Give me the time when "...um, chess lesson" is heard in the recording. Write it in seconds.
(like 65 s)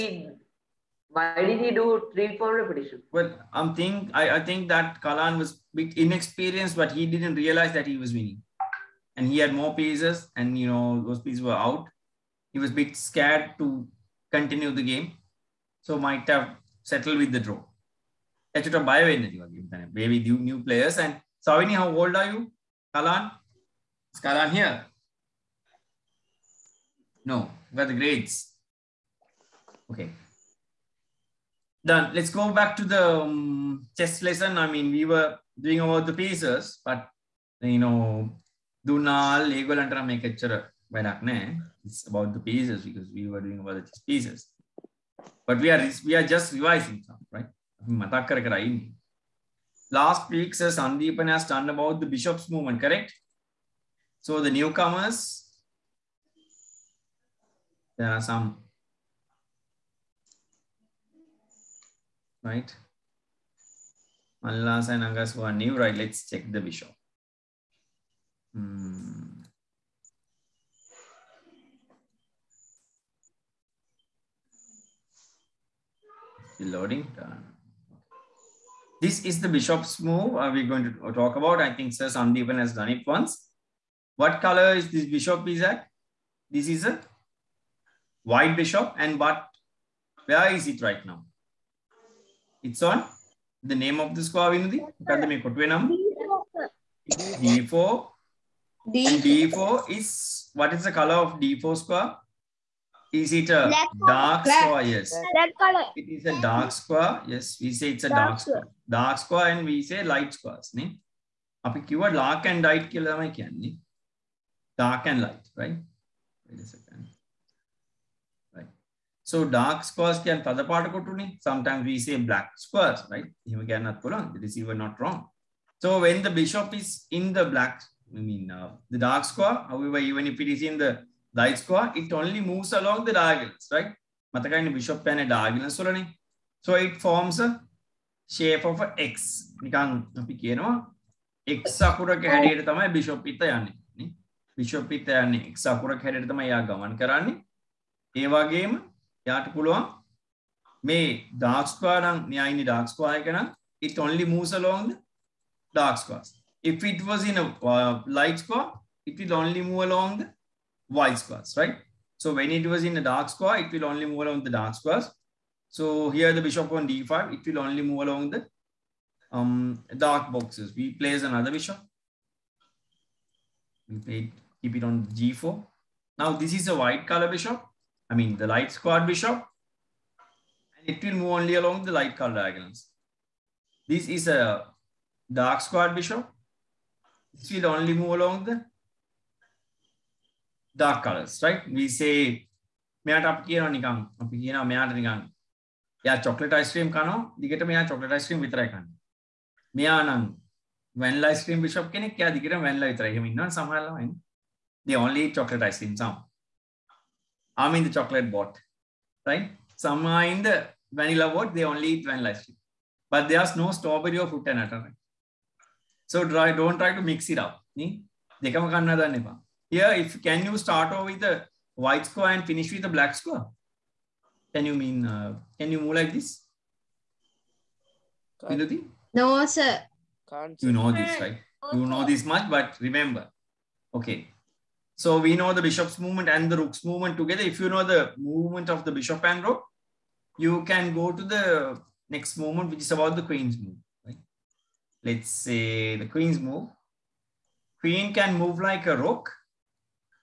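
33 s.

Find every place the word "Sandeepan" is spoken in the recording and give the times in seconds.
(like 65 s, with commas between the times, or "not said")
50 s, 82 s.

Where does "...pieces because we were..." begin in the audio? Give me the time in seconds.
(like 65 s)
42 s.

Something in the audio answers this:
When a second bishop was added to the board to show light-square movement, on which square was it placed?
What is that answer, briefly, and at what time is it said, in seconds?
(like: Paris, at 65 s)
g4, at 175 s.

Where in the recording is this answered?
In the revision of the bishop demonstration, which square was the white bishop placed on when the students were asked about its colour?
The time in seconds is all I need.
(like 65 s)
94 s.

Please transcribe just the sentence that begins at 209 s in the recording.
Some are in the vanilla bot, they only eat vanilla ice cream.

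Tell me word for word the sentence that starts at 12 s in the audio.
He was bit scared to continue the game.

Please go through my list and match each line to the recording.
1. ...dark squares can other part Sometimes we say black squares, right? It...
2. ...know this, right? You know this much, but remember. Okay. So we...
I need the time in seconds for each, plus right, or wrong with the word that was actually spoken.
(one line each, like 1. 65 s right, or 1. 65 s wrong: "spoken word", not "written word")
1. 119 s right
2. 230 s right.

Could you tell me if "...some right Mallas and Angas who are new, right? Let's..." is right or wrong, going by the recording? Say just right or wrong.
right.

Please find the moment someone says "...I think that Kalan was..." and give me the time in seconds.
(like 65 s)
4 s.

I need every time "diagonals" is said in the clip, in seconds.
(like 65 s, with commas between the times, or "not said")
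133 s, 182 s.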